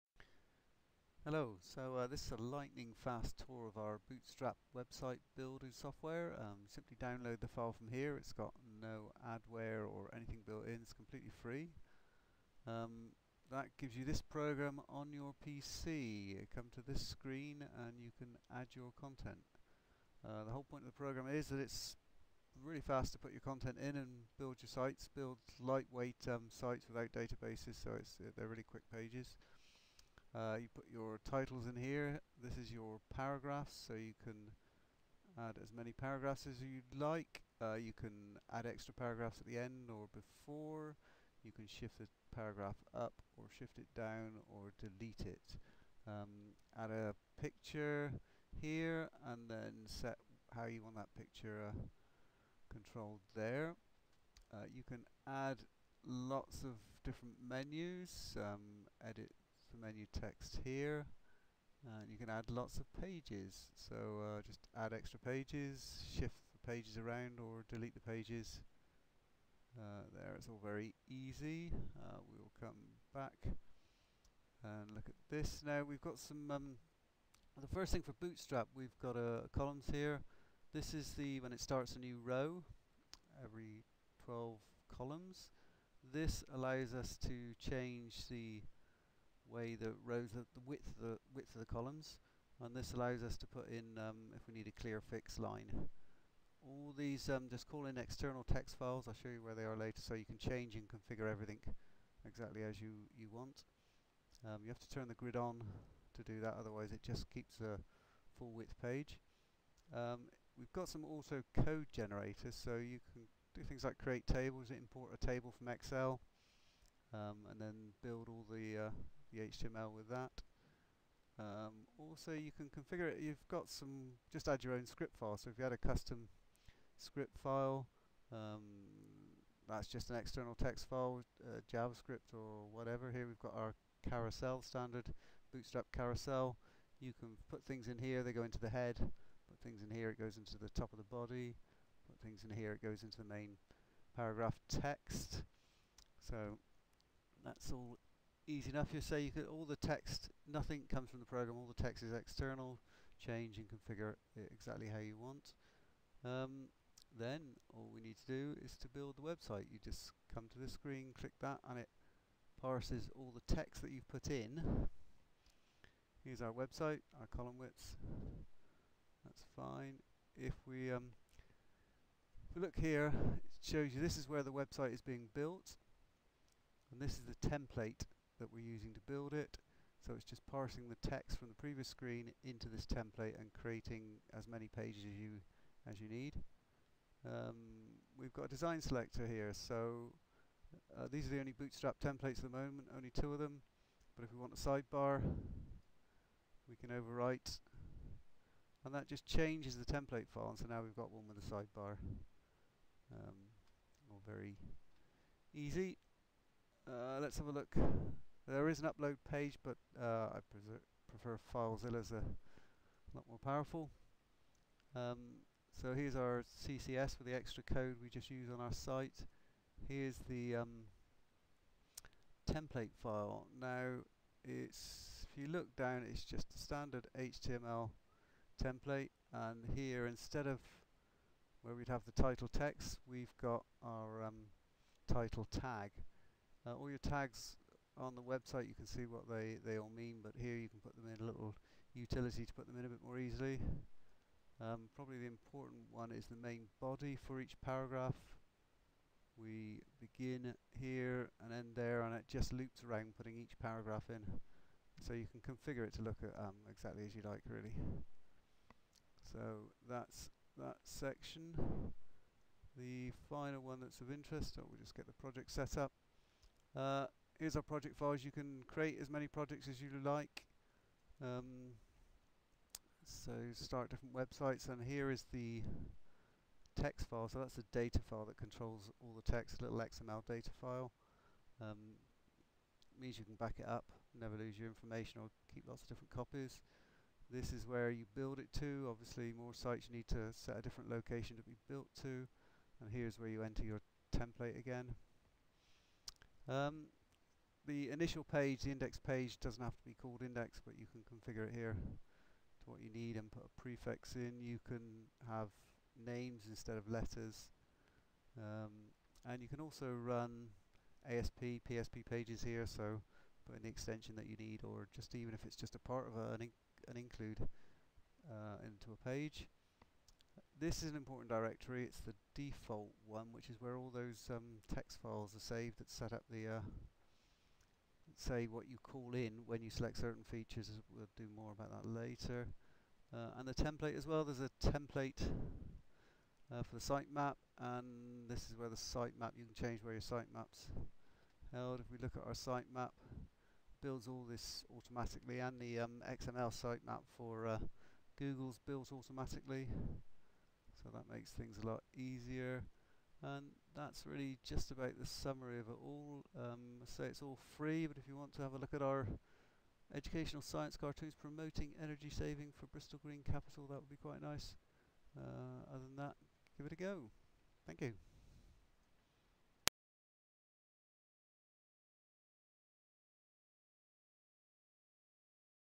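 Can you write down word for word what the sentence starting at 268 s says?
You can create as many projects as you like.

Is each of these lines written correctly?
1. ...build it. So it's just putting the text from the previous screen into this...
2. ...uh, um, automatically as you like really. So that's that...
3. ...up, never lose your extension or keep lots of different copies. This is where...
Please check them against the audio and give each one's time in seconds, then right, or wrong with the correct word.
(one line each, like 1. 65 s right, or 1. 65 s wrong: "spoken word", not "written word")
1. 179 s wrong: "parsing", not "putting"
2. 256 s wrong: "exactly", not "automatically"
3. 283 s wrong: "information", not "extension".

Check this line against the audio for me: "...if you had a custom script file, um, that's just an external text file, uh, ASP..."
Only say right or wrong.
wrong.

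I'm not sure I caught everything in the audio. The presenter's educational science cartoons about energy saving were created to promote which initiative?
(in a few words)
Bristol Green Capital.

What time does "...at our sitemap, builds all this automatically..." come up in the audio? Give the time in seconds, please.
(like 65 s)
342 s.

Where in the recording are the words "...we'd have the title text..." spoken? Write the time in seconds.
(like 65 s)
231 s.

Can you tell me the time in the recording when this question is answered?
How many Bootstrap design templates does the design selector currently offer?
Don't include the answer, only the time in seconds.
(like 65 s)
192 s.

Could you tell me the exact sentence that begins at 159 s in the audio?
You just come to this screen, click that, and it parses all the text that you've put in.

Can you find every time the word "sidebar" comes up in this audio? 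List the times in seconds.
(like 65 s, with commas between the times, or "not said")
194 s, 201 s.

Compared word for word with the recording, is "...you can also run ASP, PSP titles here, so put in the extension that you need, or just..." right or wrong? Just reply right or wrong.
wrong.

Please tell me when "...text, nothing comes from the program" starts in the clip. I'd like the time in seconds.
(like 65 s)
149 s.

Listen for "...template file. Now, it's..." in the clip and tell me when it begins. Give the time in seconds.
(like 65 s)
222 s.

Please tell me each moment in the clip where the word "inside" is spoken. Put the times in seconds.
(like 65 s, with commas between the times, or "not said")
not said.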